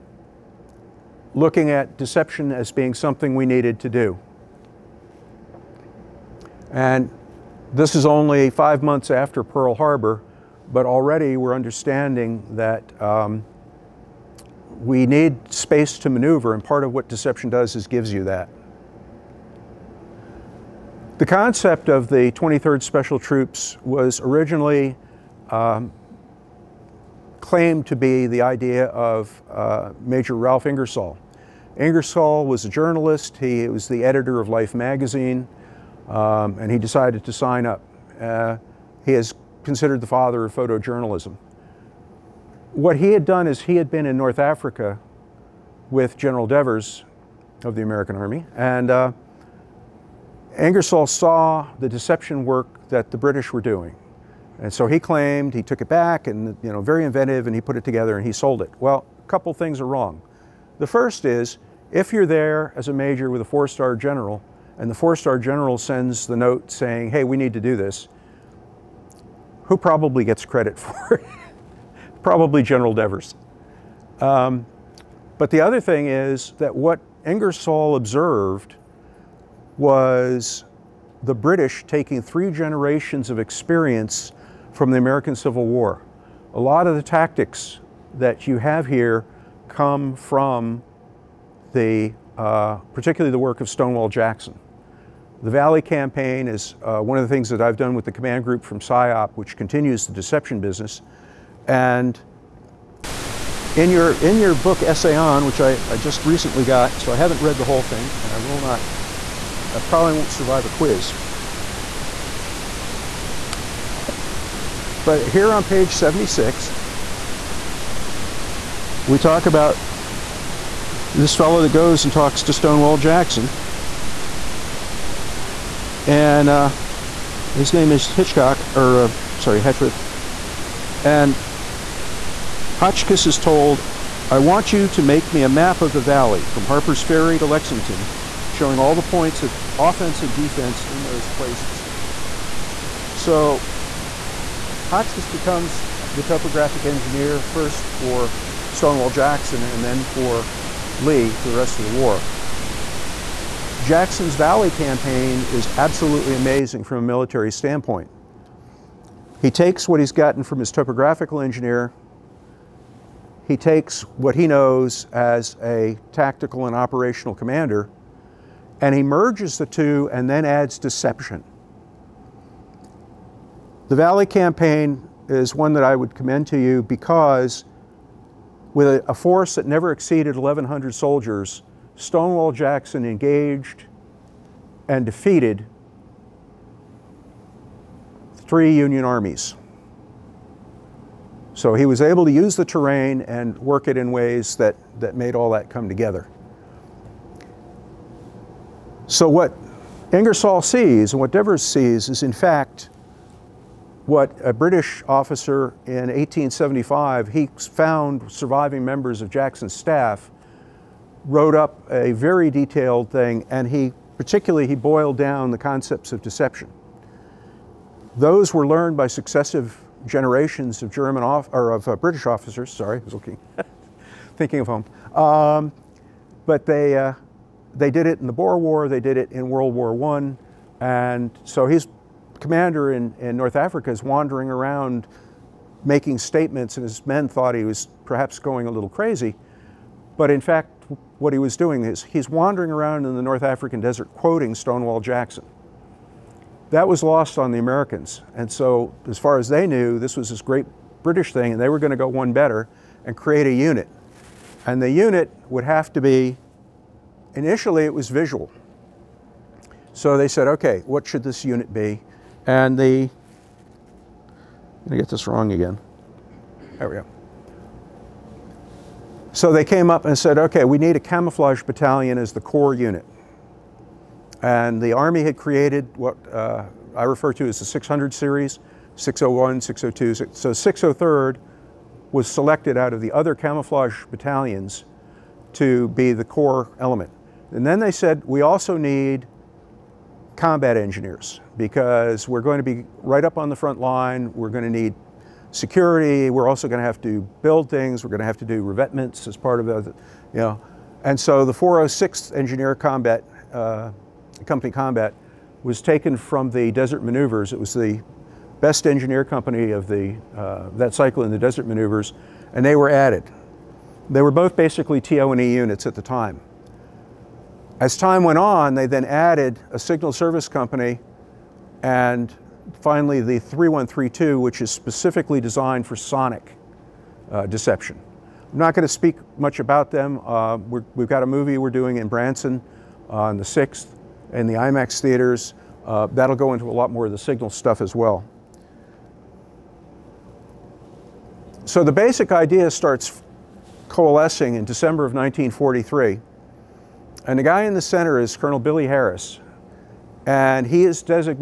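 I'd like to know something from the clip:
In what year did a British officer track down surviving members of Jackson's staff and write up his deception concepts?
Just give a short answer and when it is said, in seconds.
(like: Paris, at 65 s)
1875, at 206 s.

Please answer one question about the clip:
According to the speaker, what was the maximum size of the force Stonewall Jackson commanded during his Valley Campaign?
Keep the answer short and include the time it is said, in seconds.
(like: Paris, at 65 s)
1,100 soldiers, at 180 s.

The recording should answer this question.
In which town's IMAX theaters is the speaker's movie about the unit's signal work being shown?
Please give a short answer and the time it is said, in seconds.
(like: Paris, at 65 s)
Branson, at 332 s.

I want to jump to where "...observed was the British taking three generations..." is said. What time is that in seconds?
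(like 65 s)
77 s.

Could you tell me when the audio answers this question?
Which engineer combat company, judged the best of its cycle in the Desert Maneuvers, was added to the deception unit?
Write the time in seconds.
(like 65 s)
301 s.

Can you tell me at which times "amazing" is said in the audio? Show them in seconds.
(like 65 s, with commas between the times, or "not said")
156 s.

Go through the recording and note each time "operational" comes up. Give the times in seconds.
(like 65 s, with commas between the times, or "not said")
166 s.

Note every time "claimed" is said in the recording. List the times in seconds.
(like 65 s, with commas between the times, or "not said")
27 s, 54 s.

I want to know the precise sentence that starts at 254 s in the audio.
And the unit would have to be initially it was visual.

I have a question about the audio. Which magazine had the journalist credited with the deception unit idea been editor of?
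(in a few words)
Life.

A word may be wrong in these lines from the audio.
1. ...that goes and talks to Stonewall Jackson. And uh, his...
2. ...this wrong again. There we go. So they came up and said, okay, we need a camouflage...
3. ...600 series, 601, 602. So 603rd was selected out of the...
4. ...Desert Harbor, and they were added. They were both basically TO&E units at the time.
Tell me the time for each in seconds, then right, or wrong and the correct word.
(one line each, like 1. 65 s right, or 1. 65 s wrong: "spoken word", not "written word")
1. 121 s right
2. 265 s right
3. 277 s right
4. 311 s wrong: "Maneuvers", not "Harbor".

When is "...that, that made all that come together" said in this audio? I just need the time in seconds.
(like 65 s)
194 s.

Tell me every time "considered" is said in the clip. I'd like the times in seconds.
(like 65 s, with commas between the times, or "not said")
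39 s.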